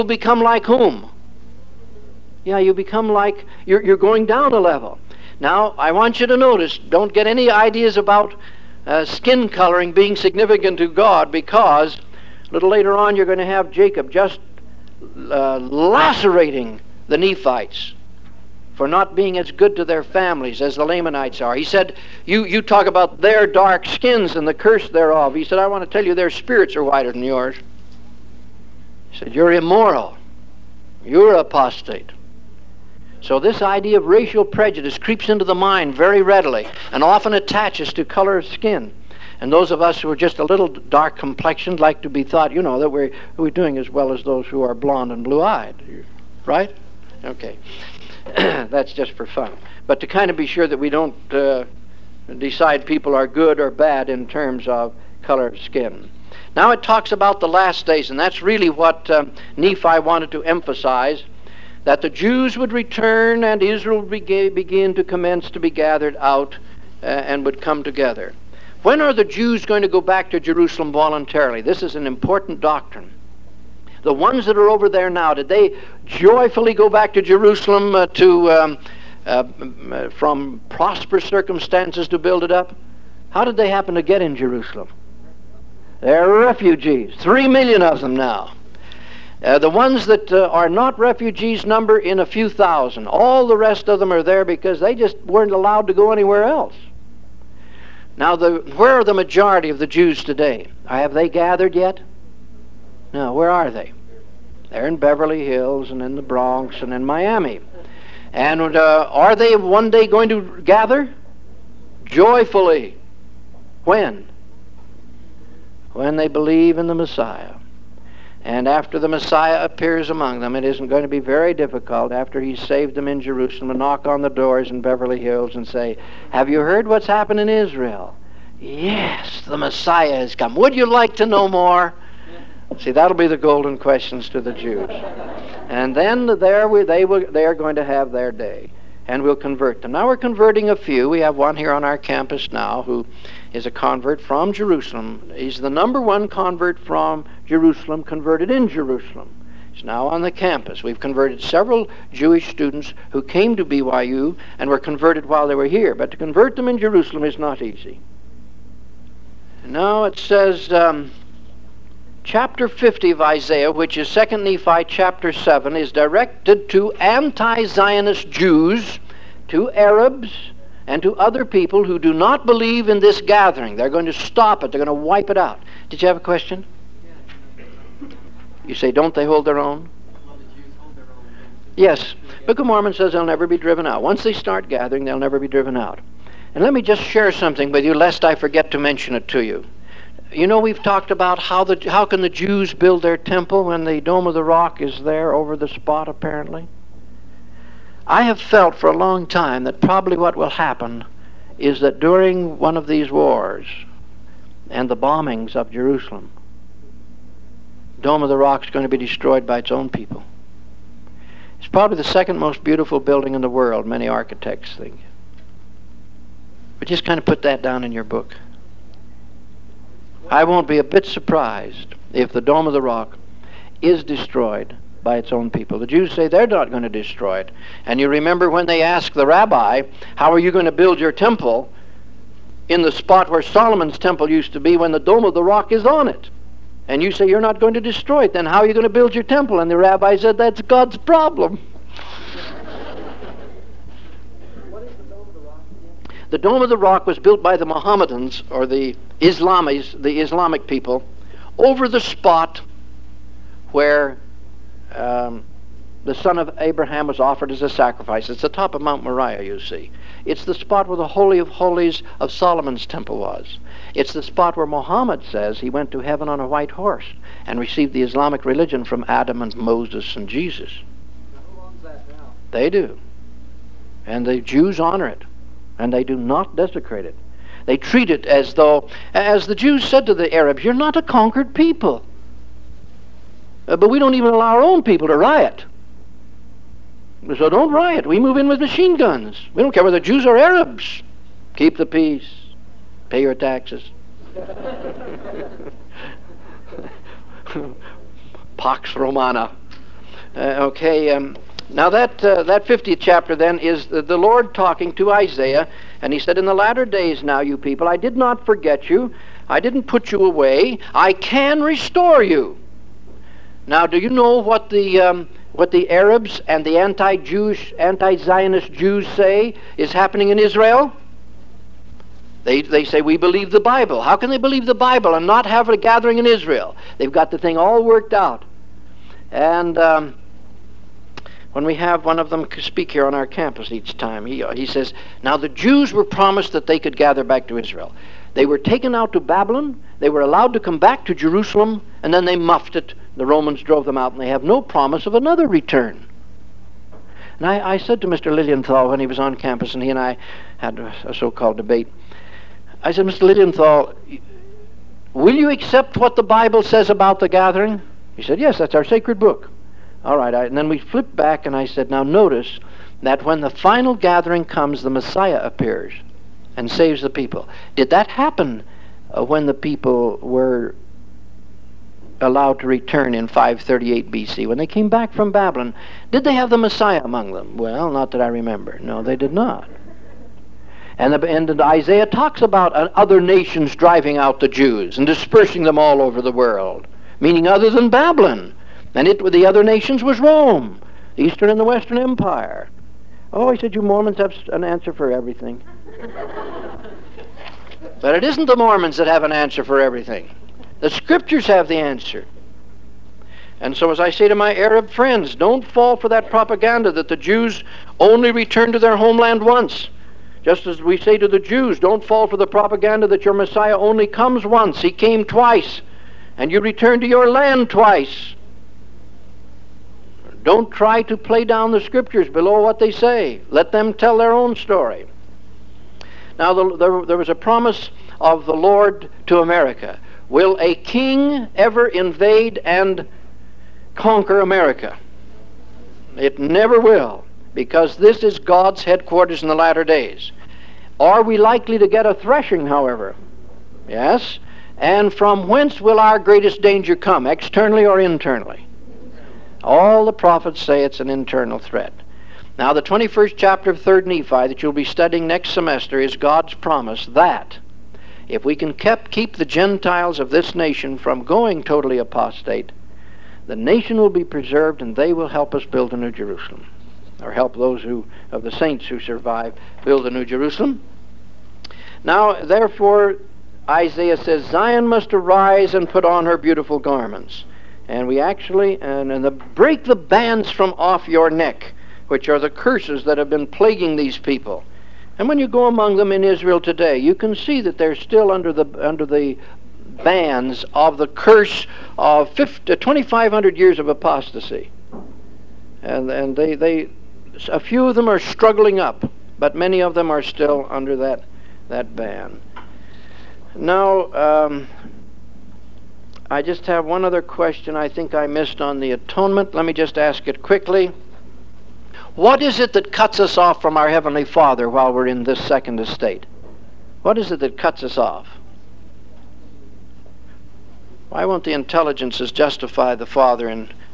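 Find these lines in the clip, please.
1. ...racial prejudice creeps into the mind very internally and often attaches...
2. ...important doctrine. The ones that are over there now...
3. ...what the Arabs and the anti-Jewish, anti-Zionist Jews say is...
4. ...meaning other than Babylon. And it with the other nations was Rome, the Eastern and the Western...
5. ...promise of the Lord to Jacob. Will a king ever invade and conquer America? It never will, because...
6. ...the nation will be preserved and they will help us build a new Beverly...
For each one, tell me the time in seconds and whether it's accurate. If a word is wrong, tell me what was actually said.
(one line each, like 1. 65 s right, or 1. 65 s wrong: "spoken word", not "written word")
1. 34 s wrong: "readily", not "internally"
2. 72 s right
3. 315 s right
4. 387 s right
5. 427 s wrong: "America", not "Jacob"
6. 463 s wrong: "Jerusalem", not "Beverly".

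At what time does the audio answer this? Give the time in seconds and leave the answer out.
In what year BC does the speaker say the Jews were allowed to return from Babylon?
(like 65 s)
373 s.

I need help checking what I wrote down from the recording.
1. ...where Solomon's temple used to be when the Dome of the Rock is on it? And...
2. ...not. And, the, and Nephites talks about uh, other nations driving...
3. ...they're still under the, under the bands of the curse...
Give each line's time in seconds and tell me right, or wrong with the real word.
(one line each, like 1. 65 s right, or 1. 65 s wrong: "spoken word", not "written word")
1. 233 s right
2. 379 s wrong: "Isaiah", not "Nephites"
3. 487 s right.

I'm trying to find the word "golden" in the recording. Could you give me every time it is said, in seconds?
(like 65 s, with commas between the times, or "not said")
133 s.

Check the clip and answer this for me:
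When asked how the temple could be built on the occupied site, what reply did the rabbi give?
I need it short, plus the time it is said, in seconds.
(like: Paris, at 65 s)
That's God's problem, at 240 s.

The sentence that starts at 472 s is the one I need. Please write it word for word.
Now, therefore, Isaiah says, Zion must arise and put on her beautiful garments.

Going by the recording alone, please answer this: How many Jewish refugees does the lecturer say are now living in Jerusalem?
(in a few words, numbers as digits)
3 million.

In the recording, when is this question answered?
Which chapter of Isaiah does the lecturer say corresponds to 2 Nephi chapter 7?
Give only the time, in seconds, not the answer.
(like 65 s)
162 s.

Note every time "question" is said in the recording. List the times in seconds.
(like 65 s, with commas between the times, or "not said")
133 s, 176 s, 507 s.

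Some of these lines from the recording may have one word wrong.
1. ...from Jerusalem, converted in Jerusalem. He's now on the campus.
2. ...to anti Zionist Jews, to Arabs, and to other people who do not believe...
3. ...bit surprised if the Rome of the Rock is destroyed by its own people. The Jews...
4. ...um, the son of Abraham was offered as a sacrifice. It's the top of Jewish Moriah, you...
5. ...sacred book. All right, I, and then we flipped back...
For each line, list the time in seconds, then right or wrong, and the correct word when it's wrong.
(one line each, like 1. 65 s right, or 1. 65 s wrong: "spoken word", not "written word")
1. 146 s right
2. 166 s right
3. 220 s wrong: "Dome", not "Rome"
4. 254 s wrong: "Mount", not "Jewish"
5. 358 s right.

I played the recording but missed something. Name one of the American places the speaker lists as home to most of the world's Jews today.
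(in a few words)
Miami.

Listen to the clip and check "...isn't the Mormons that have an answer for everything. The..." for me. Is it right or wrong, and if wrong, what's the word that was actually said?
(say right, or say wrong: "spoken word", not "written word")
right.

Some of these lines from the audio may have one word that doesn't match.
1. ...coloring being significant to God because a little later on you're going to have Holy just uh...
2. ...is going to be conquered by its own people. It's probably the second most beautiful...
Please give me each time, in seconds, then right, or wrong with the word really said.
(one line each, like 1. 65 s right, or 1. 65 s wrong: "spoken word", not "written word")
1. 9 s wrong: "Jacob", not "Holy"
2. 208 s wrong: "destroyed", not "conquered".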